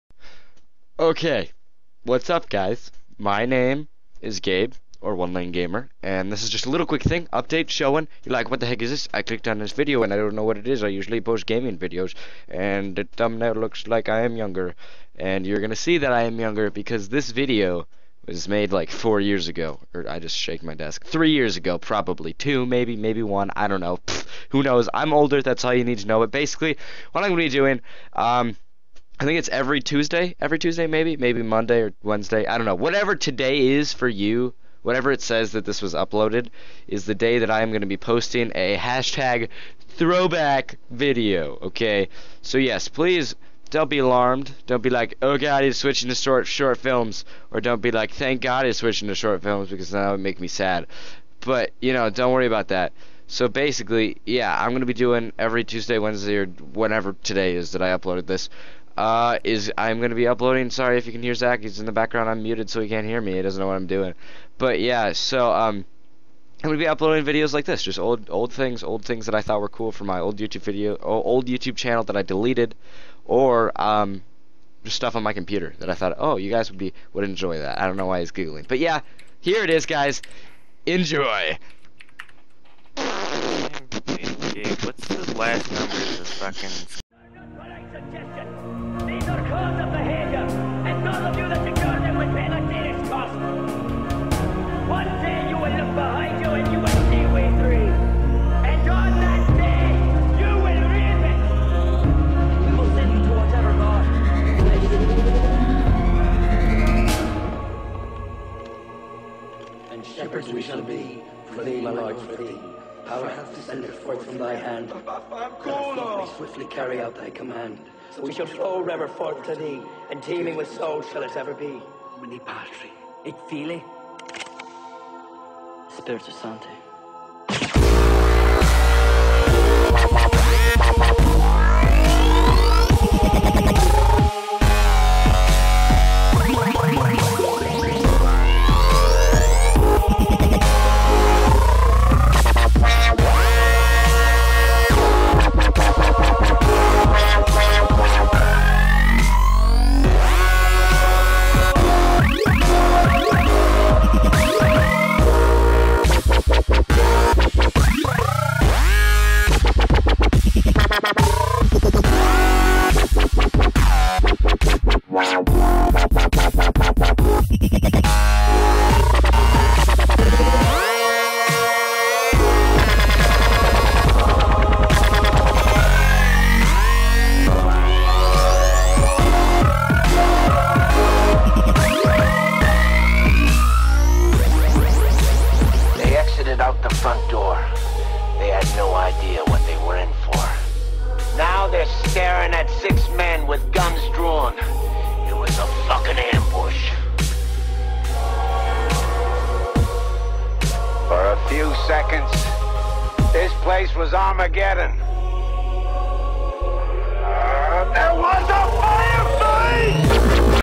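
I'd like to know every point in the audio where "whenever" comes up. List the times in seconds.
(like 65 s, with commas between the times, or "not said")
56 s.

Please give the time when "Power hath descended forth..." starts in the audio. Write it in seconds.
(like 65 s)
113 s.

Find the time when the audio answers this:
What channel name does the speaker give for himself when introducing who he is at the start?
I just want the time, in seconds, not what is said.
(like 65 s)
5 s.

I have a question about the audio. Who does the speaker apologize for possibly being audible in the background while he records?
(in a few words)
Zach.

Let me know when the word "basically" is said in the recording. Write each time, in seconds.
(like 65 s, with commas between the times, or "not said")
26 s, 53 s.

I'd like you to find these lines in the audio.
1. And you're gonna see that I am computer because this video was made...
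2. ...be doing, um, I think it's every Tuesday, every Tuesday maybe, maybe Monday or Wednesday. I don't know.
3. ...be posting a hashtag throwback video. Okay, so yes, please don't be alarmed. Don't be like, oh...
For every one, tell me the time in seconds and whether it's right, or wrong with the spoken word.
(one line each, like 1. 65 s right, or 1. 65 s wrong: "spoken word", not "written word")
1. 15 s wrong: "younger", not "computer"
2. 27 s right
3. 37 s right.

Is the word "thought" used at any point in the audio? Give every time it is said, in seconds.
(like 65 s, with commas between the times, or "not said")
69 s, 75 s.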